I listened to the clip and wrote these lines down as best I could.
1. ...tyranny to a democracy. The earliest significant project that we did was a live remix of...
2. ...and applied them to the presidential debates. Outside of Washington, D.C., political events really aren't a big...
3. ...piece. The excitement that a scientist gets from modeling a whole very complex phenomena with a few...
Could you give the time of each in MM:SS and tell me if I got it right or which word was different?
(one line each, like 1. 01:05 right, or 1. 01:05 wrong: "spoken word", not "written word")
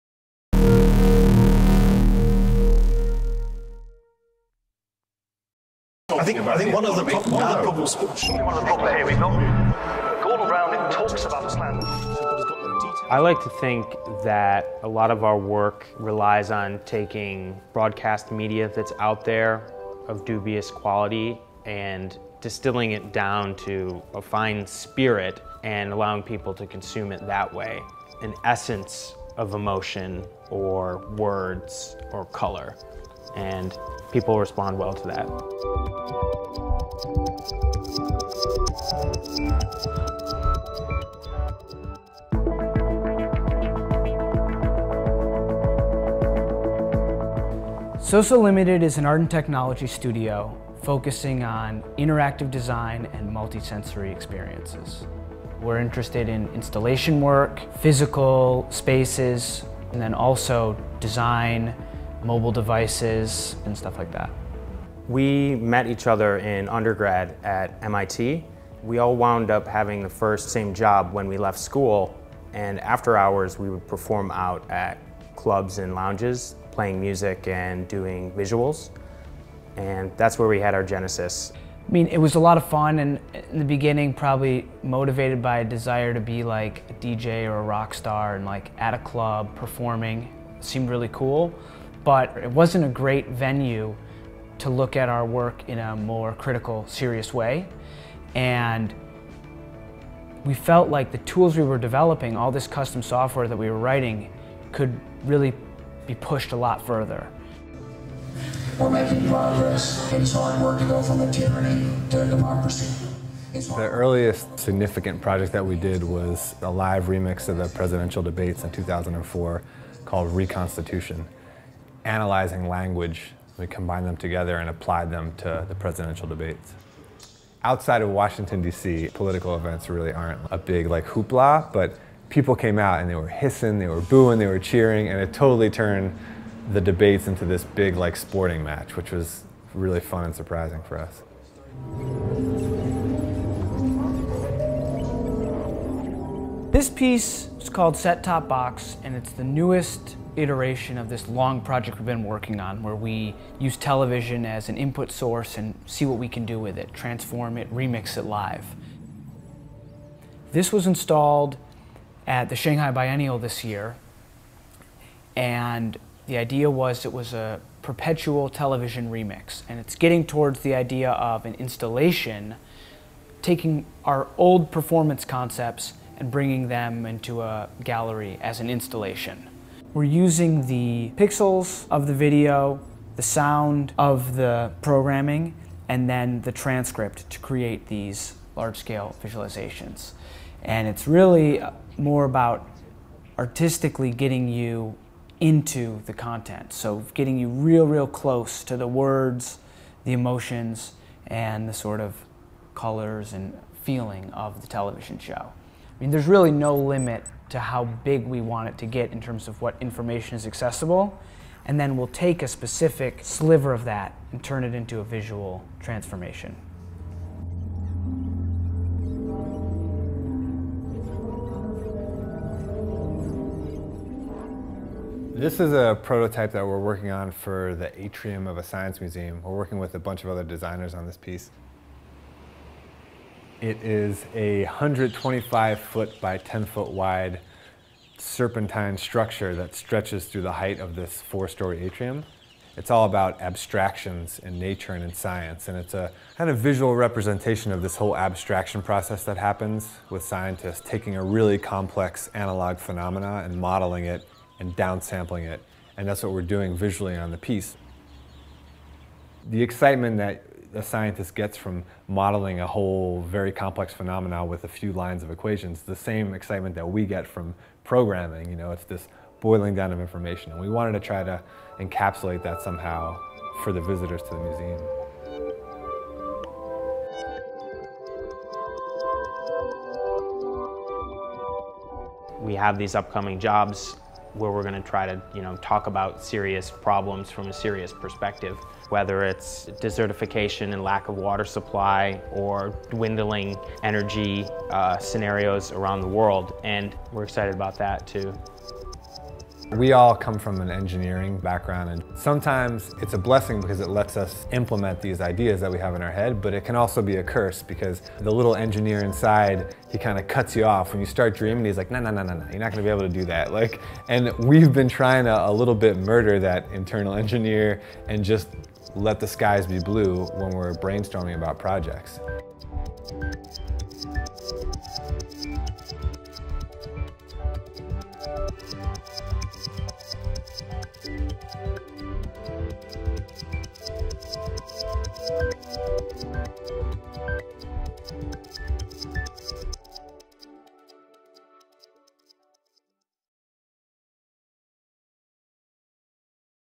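1. 01:51 right
2. 02:04 right
3. 04:17 right.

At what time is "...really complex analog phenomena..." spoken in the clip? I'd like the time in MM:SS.
04:11.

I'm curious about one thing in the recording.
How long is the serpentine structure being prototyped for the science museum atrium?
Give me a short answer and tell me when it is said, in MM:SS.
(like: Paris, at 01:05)
125 feet, at 03:54.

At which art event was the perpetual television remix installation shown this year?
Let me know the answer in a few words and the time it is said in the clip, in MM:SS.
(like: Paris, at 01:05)
Shanghai Biennial, at 02:42.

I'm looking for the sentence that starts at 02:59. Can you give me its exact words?
We're using the pixels of the video, the sound of the programming, and then the transcript to create these large-scale visualizations.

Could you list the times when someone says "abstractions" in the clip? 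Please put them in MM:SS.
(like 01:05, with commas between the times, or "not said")
04:03, 04:08.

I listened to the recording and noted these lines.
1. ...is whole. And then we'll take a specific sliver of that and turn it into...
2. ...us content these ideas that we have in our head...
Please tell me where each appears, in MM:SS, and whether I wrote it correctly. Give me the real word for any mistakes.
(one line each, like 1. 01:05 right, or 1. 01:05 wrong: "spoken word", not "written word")
1. 03:30 wrong: "accessible", not "whole"
2. 05:04 wrong: "implement", not "content".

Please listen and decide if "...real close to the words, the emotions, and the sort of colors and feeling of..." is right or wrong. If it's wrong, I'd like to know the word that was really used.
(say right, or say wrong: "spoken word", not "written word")
right.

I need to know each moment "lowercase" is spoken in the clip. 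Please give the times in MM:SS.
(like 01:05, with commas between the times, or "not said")
not said.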